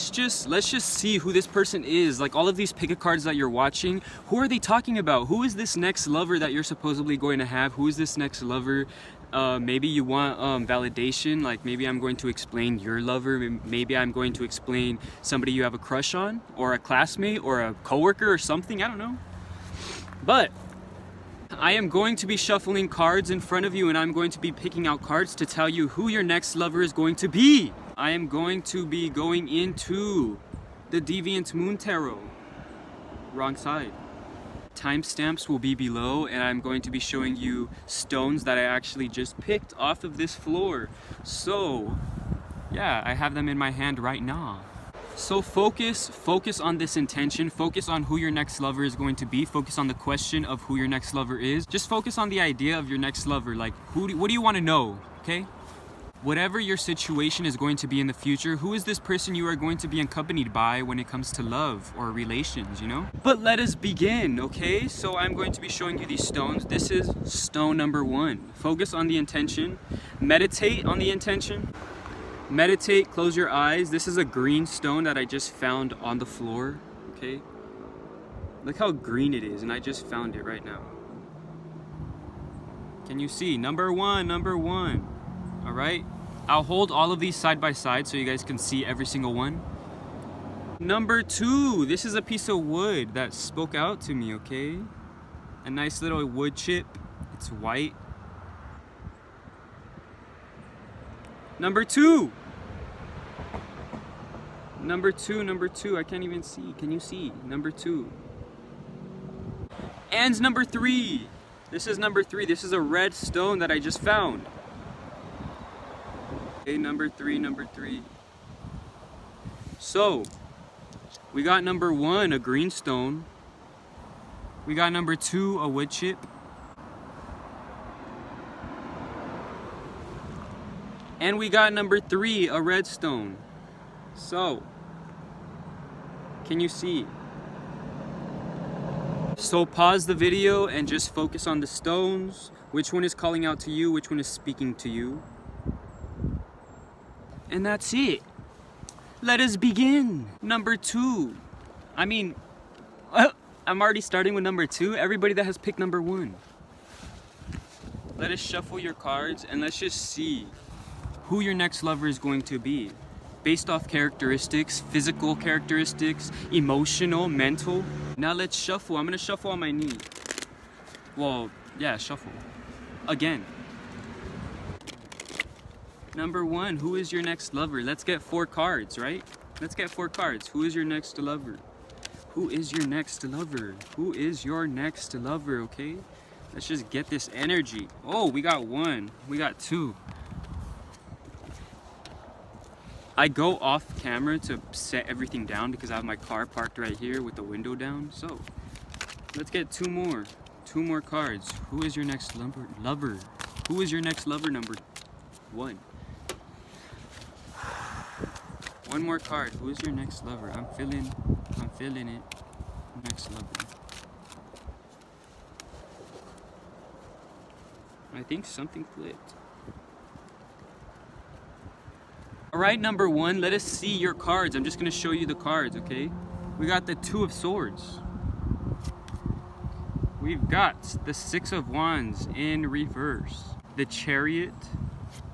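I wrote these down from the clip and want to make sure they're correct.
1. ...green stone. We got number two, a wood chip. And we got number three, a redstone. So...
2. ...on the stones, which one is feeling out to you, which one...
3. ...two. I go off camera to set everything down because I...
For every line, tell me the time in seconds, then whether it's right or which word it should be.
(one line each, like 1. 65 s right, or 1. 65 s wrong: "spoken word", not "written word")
1. 122 s right
2. 141 s wrong: "calling", not "feeling"
3. 189 s right.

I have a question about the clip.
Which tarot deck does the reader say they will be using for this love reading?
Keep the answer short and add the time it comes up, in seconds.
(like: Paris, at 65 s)
Deviant Moon Tarot, at 31 s.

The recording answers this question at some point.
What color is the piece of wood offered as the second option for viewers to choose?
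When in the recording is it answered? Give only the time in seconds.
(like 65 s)
97 s.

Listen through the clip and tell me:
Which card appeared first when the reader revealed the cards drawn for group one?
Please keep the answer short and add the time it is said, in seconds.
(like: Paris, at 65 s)
Two of Swords, at 226 s.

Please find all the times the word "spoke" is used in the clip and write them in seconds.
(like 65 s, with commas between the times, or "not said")
93 s.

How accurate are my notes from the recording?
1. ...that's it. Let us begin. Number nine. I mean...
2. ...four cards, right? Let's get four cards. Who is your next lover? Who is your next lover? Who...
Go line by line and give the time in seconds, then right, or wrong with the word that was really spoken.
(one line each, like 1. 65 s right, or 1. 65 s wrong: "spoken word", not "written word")
1. 147 s wrong: "two", not "nine"
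2. 178 s right.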